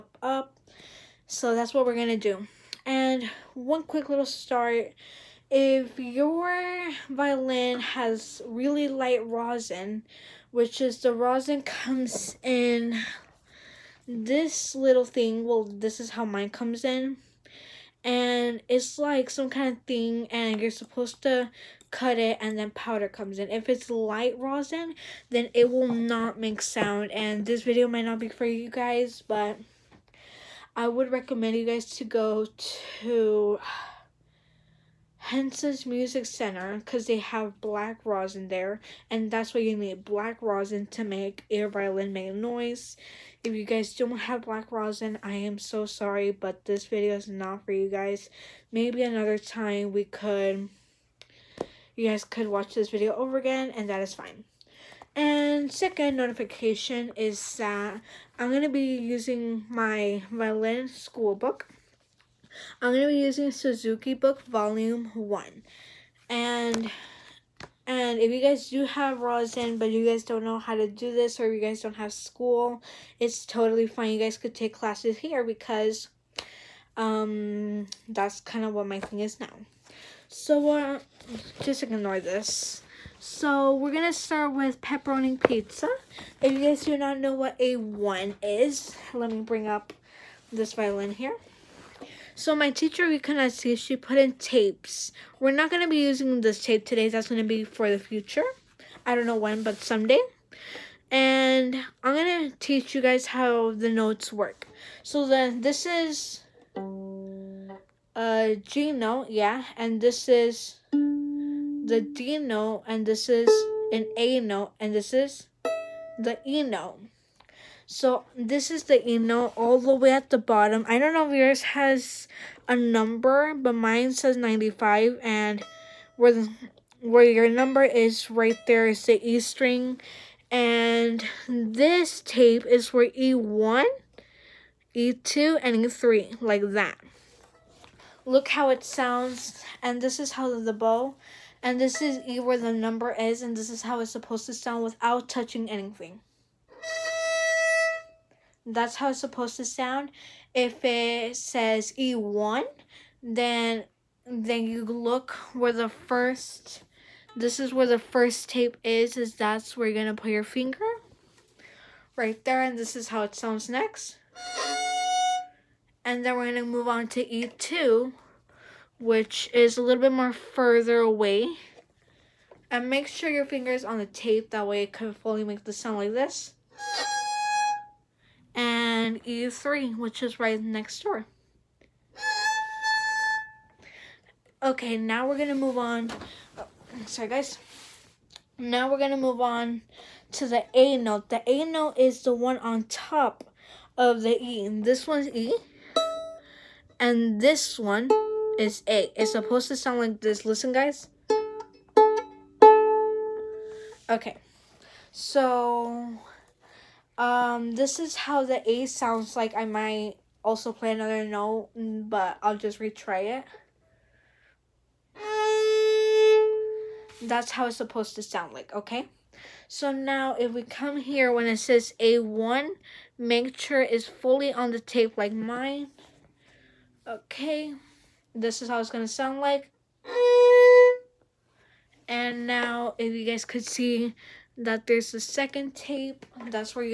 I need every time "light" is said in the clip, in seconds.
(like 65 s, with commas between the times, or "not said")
8 s, 23 s.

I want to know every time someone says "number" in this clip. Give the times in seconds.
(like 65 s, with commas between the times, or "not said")
122 s, 127 s, 142 s.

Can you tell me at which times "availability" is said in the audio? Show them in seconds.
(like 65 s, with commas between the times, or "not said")
not said.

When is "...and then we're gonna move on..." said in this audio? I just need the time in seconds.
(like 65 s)
166 s.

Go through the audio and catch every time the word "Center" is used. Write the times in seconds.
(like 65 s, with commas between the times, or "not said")
36 s.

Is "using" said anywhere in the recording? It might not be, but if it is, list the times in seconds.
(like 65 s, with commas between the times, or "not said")
58 s, 63 s, 96 s.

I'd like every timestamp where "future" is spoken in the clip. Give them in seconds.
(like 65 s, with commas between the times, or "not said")
98 s.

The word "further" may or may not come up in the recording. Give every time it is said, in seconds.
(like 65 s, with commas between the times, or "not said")
170 s.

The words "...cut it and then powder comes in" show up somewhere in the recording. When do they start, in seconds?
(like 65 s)
21 s.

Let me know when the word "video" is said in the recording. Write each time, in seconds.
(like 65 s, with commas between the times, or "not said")
27 s, 46 s, 52 s.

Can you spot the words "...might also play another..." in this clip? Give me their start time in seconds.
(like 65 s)
209 s.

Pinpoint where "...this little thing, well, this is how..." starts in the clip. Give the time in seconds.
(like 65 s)
14 s.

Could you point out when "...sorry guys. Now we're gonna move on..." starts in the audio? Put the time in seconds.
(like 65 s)
187 s.